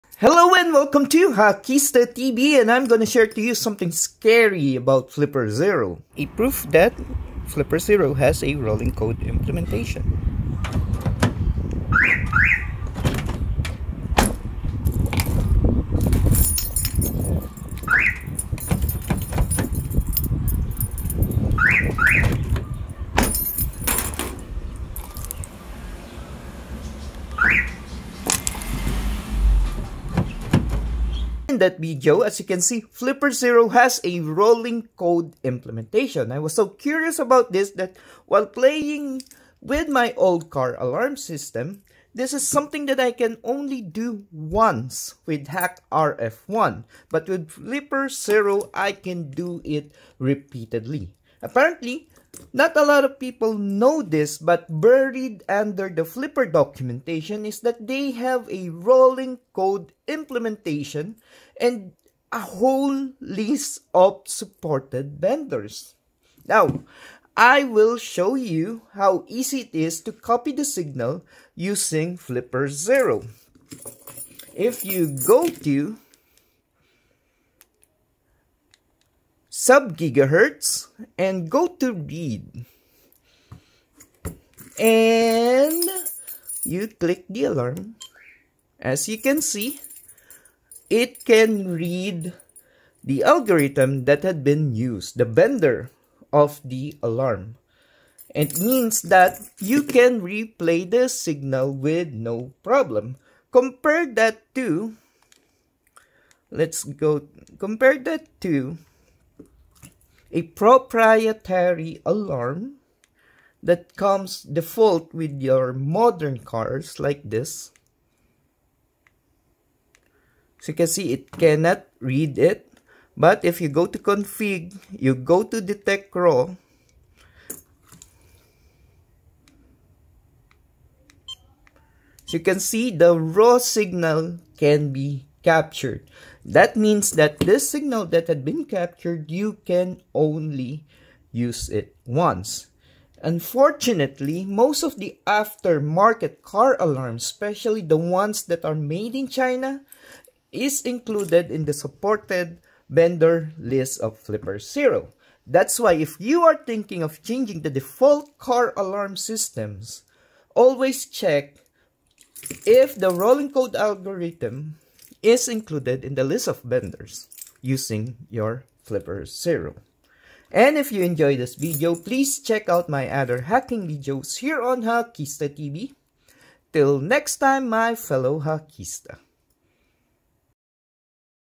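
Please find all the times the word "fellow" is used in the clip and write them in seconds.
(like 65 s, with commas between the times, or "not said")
177 s.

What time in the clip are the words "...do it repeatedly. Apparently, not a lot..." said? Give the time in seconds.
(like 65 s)
49 s.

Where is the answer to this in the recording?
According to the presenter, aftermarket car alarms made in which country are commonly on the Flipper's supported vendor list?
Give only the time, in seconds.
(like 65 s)
149 s.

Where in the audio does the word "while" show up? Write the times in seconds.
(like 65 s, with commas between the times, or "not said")
38 s.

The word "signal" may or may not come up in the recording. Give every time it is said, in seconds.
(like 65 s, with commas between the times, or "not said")
70 s, 101 s, 133 s, 137 s.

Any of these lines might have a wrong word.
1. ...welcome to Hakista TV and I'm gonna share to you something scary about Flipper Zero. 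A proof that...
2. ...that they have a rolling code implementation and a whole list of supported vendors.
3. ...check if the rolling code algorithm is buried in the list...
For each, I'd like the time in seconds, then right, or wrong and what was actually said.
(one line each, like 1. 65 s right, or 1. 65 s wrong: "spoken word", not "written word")
1. 0 s right
2. 57 s right
3. 161 s wrong: "included", not "buried".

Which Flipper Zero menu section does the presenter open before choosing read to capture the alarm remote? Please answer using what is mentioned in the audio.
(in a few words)
Sub gigahertz.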